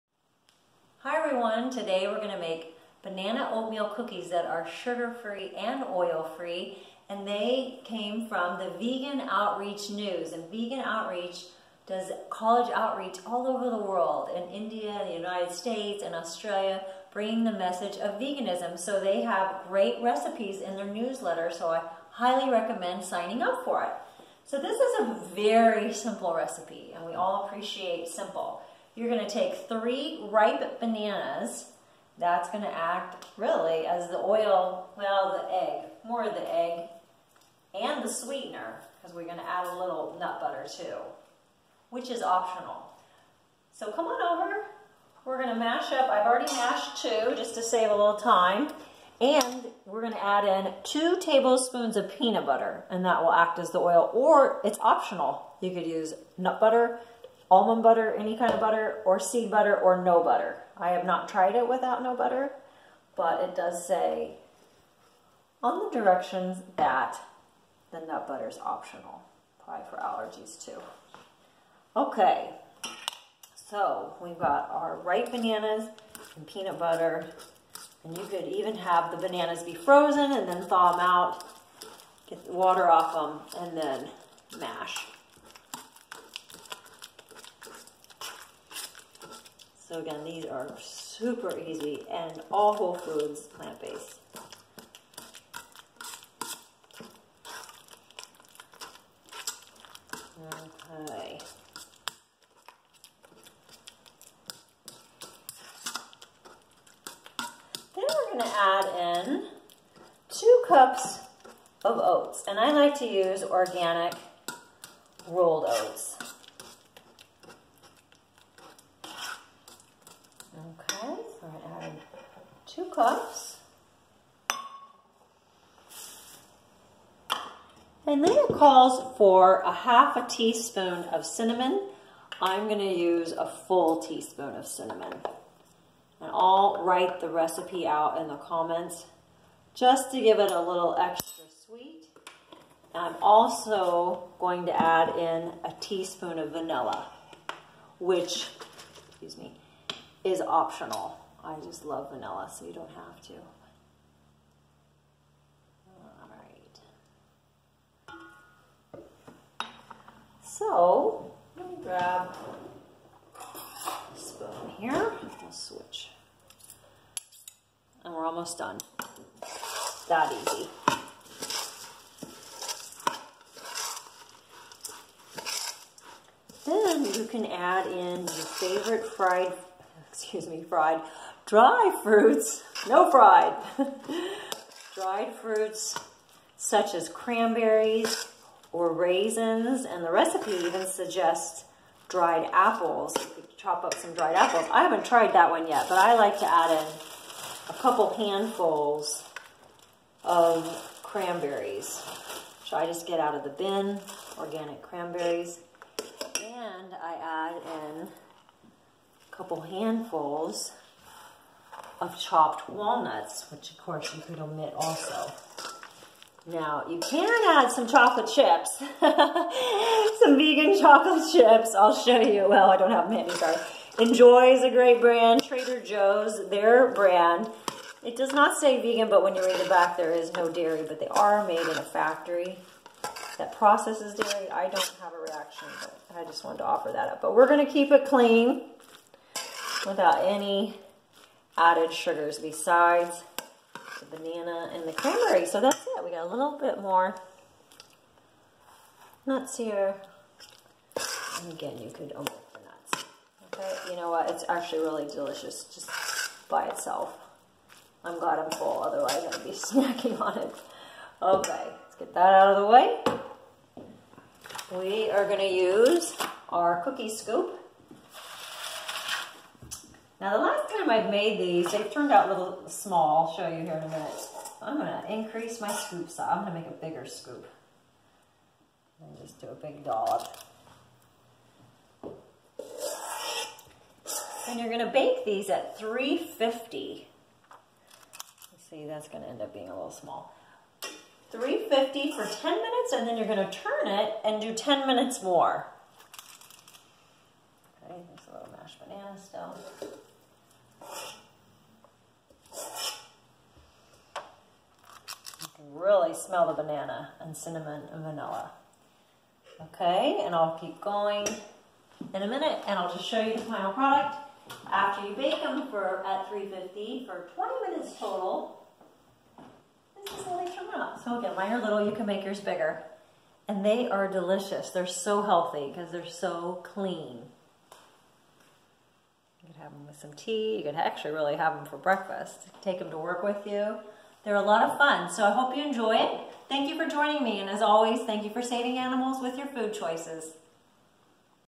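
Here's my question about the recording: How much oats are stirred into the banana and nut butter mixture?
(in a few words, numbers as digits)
2 cups.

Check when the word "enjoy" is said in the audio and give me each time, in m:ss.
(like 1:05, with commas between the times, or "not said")
3:43, 5:35.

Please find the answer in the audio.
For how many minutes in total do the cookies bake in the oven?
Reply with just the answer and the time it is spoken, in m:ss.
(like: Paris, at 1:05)
20 minutes, at 5:17.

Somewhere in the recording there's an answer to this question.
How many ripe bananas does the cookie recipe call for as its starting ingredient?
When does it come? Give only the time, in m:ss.
0:29.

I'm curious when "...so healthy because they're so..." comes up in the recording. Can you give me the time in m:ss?
5:24.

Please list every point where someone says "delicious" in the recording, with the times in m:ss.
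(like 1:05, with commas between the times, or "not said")
4:15, 5:24.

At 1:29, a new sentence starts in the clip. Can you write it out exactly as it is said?
So again, these are super easy and all whole foods, plant-based.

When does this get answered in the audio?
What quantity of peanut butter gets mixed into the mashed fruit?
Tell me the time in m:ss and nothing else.
0:50.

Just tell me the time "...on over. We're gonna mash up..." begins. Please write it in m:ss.
0:44.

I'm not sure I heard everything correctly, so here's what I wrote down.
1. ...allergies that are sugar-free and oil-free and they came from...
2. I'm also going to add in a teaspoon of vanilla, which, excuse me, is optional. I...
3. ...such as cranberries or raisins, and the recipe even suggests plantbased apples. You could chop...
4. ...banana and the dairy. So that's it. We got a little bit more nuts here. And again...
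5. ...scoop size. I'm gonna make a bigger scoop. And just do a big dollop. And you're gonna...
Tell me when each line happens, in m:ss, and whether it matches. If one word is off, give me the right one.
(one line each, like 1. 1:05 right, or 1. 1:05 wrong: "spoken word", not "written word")
1. 0:03 wrong: "cookies", not "allergies"
2. 2:22 right
3. 3:06 wrong: "dried", not "plantbased"
4. 4:04 wrong: "cranberry", not "dairy"
5. 4:35 right.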